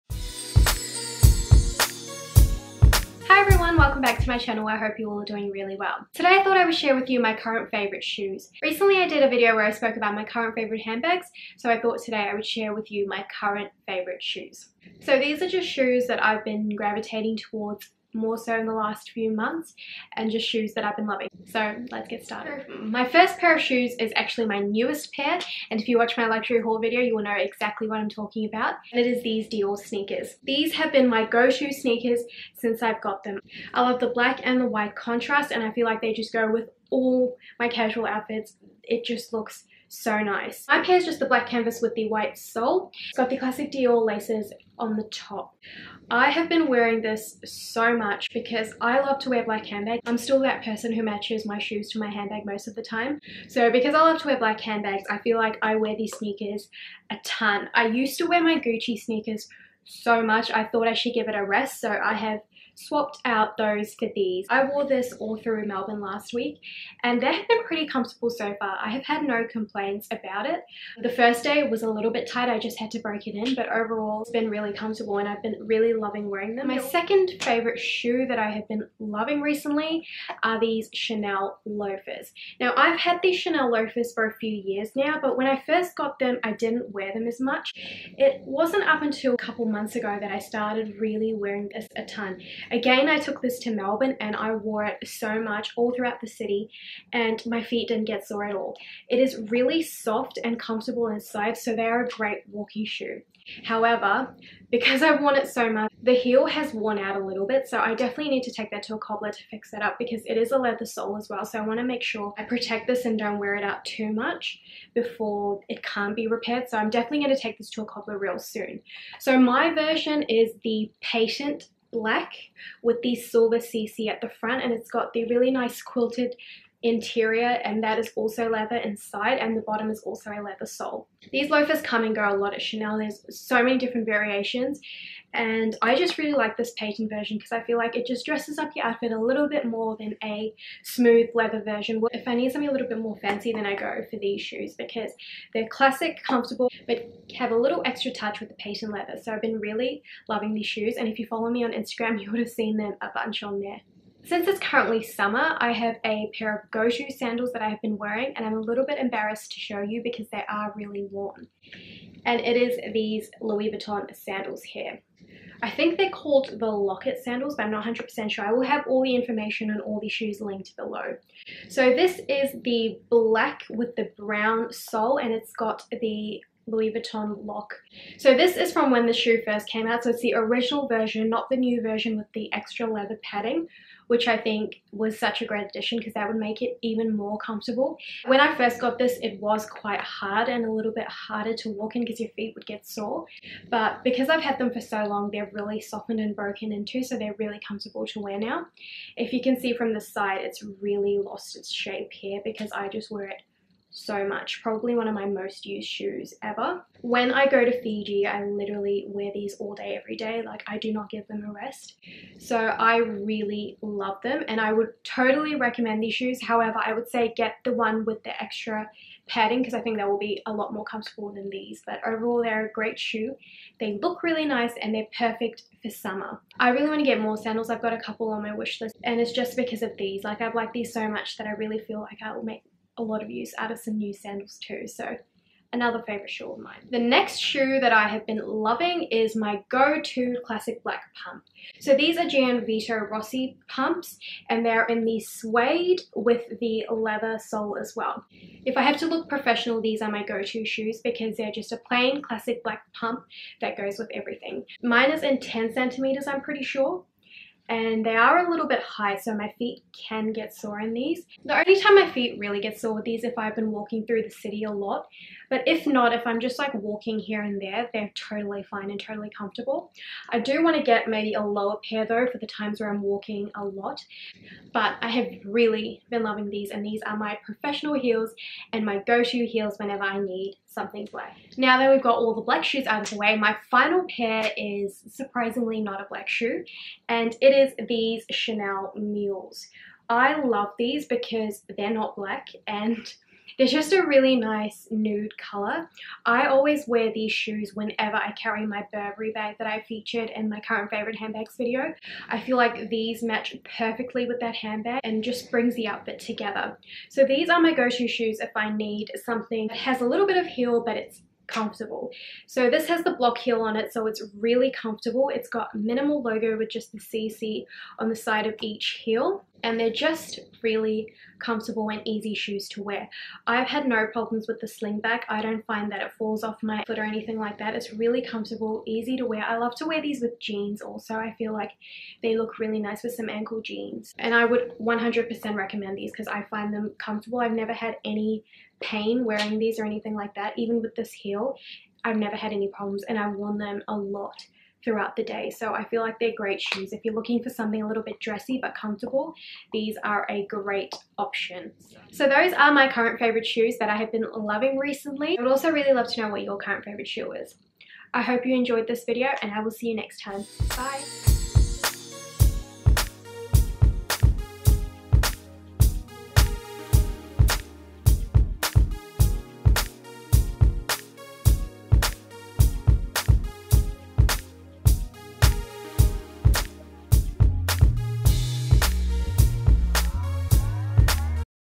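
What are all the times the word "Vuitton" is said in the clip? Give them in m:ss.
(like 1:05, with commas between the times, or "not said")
2:43, 2:56.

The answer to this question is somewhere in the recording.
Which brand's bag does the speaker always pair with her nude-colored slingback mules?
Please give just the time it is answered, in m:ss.
4:58.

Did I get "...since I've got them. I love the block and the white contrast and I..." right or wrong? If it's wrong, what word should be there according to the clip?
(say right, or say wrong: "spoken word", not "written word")
wrong: "black", not "block".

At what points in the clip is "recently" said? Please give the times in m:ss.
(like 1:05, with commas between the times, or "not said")
0:08, 1:19, 5:54.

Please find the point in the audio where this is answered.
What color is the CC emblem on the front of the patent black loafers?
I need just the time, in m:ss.
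2:03.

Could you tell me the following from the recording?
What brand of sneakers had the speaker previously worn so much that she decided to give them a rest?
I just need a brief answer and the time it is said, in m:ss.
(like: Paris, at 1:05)
Gucci, at 0:58.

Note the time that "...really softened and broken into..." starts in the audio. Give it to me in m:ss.
3:15.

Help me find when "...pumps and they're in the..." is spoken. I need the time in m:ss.
4:03.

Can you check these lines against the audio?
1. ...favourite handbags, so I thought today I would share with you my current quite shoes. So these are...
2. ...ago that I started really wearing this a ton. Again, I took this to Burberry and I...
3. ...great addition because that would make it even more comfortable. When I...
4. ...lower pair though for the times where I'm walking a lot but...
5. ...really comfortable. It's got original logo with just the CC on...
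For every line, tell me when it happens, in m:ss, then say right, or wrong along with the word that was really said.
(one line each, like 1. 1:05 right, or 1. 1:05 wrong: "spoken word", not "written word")
1. 0:10 wrong: "favourite", not "quite"
2. 1:29 wrong: "Melbourne", not "Burberry"
3. 3:05 right
4. 4:31 right
5. 5:14 wrong: "minimal", not "original".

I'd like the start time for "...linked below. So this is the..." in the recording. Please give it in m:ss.
2:50.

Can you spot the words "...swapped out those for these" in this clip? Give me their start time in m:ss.
1:02.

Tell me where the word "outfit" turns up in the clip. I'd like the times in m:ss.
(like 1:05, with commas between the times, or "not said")
0:38, 2:18, 5:05.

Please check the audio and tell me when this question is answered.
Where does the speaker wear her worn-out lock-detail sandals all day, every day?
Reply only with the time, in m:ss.
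3:27.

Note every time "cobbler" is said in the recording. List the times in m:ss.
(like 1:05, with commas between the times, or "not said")
1:48, 1:57.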